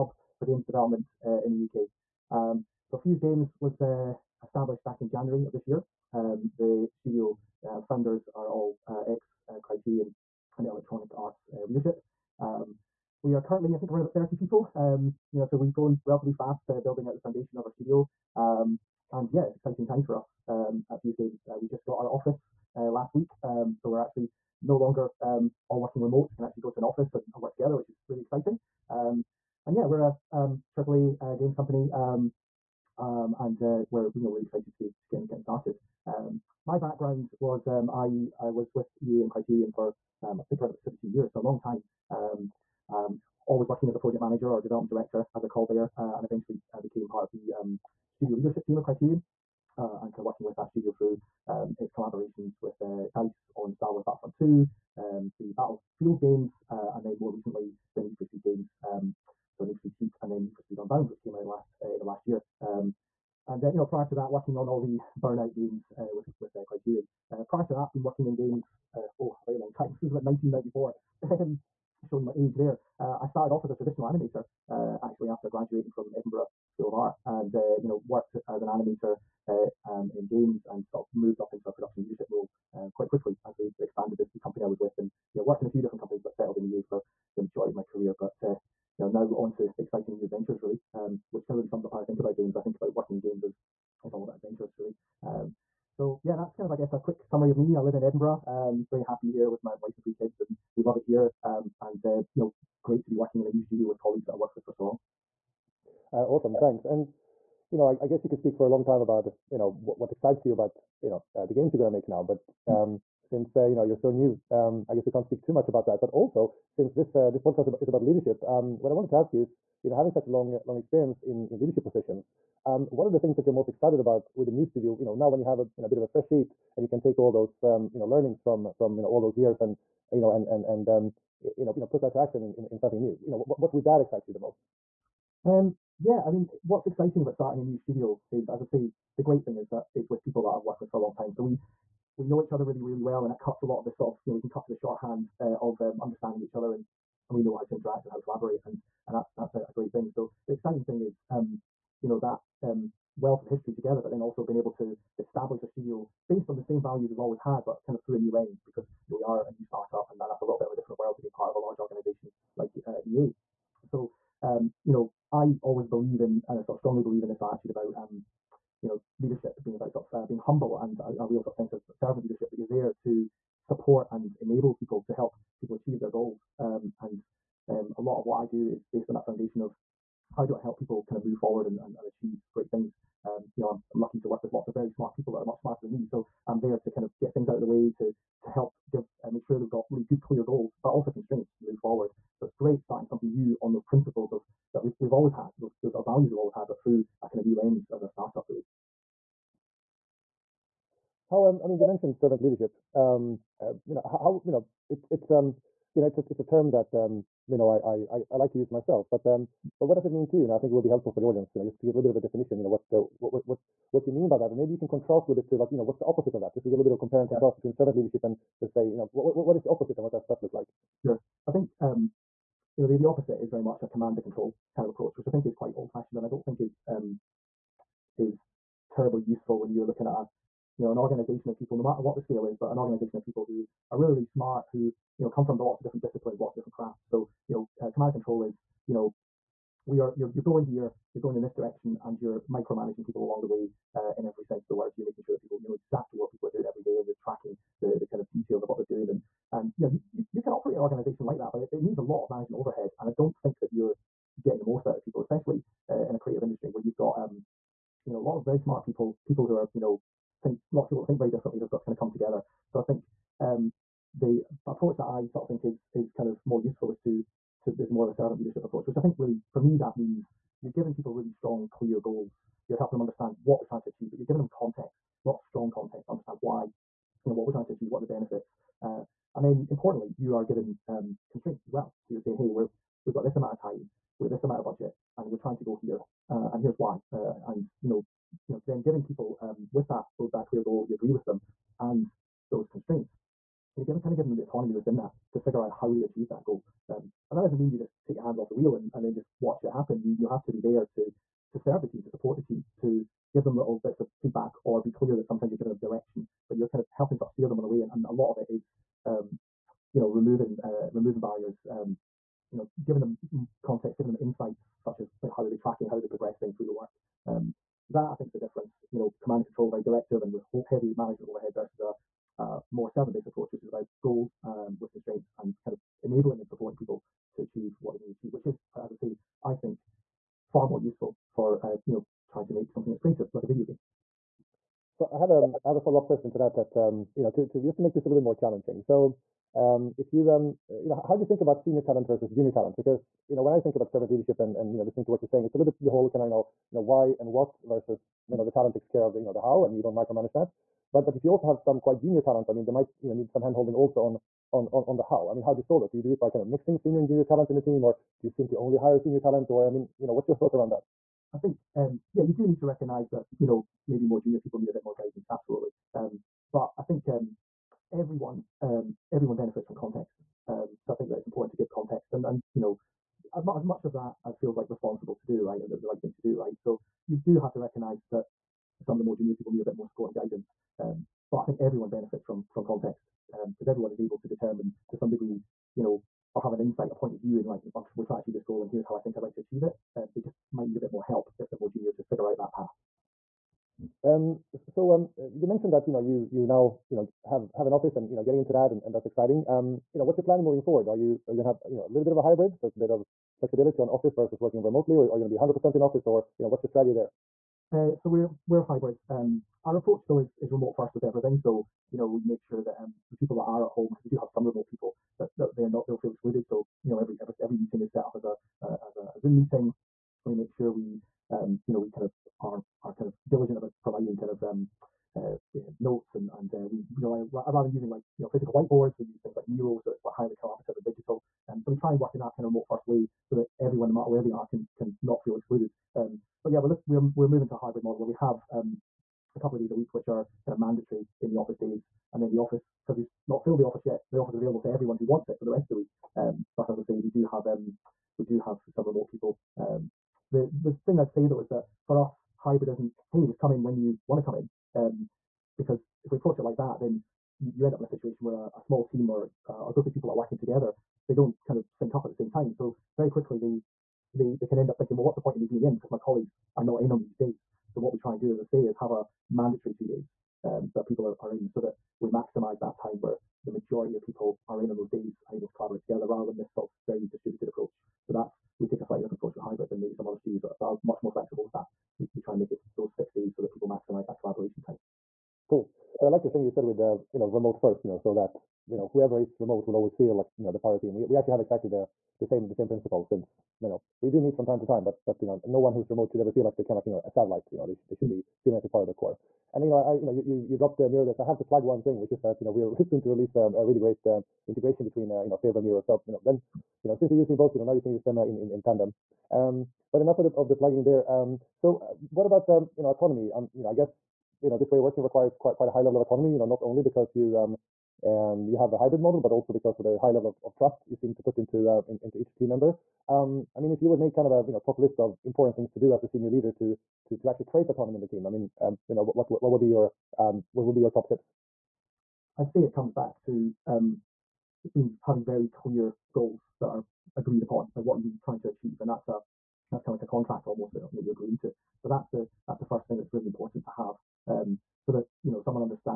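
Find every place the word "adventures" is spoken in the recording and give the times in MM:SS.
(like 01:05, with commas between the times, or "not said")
01:30, 01:34.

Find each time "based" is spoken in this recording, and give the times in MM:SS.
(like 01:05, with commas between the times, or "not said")
02:36, 02:58, 05:23.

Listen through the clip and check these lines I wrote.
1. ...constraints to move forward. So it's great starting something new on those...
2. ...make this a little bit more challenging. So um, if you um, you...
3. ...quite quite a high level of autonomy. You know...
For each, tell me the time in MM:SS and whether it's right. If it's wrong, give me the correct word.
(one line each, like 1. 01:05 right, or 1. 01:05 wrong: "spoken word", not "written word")
1. 03:11 right
2. 05:37 right
3. 08:35 right.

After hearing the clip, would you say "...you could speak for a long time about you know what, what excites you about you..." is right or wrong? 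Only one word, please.
right.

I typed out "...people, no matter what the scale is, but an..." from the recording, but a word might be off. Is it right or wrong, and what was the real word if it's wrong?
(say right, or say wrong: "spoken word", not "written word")
right.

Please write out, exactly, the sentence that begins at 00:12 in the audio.
Um, we are currently, I think, around about 30 people.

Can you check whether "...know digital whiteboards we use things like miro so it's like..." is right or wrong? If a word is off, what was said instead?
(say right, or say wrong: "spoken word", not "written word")
wrong: "physical", not "digital".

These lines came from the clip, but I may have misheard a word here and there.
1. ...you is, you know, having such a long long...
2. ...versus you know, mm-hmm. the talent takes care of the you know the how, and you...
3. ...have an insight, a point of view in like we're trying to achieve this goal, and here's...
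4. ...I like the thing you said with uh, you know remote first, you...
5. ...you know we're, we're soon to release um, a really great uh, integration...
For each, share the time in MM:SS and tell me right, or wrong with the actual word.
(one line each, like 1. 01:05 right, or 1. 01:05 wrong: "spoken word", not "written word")
1. 01:59 right
2. 05:47 right
3. 06:26 right
4. 08:06 right
5. 08:22 right.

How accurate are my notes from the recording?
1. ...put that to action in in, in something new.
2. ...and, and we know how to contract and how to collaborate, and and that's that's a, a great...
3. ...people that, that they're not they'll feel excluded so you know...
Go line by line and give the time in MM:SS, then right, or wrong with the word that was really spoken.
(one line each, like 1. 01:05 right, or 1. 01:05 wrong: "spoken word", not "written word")
1. 02:11 right
2. 02:26 wrong: "interact", not "contract"
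3. 06:54 right.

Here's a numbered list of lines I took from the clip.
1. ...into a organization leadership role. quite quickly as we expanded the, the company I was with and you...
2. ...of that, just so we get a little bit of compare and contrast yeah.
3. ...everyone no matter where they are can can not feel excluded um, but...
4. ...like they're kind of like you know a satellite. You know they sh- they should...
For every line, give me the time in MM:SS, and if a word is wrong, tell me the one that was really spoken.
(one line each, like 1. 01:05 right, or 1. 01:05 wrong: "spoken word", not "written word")
1. 01:21 wrong: "production", not "organization"
2. 03:36 right
3. 07:13 right
4. 08:16 right.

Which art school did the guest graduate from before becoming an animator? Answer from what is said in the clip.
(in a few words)
Edinburgh School of Art.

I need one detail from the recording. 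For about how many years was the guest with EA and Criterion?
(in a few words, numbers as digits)
17 years.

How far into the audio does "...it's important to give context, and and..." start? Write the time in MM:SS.
06:11.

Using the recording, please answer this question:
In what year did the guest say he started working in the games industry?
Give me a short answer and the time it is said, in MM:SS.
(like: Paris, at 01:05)
1994, at 01:10.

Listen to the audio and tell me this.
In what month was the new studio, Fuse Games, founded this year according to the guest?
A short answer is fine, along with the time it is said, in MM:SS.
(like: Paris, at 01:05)
January, at 00:05.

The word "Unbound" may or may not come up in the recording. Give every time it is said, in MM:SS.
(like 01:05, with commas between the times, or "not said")
01:00.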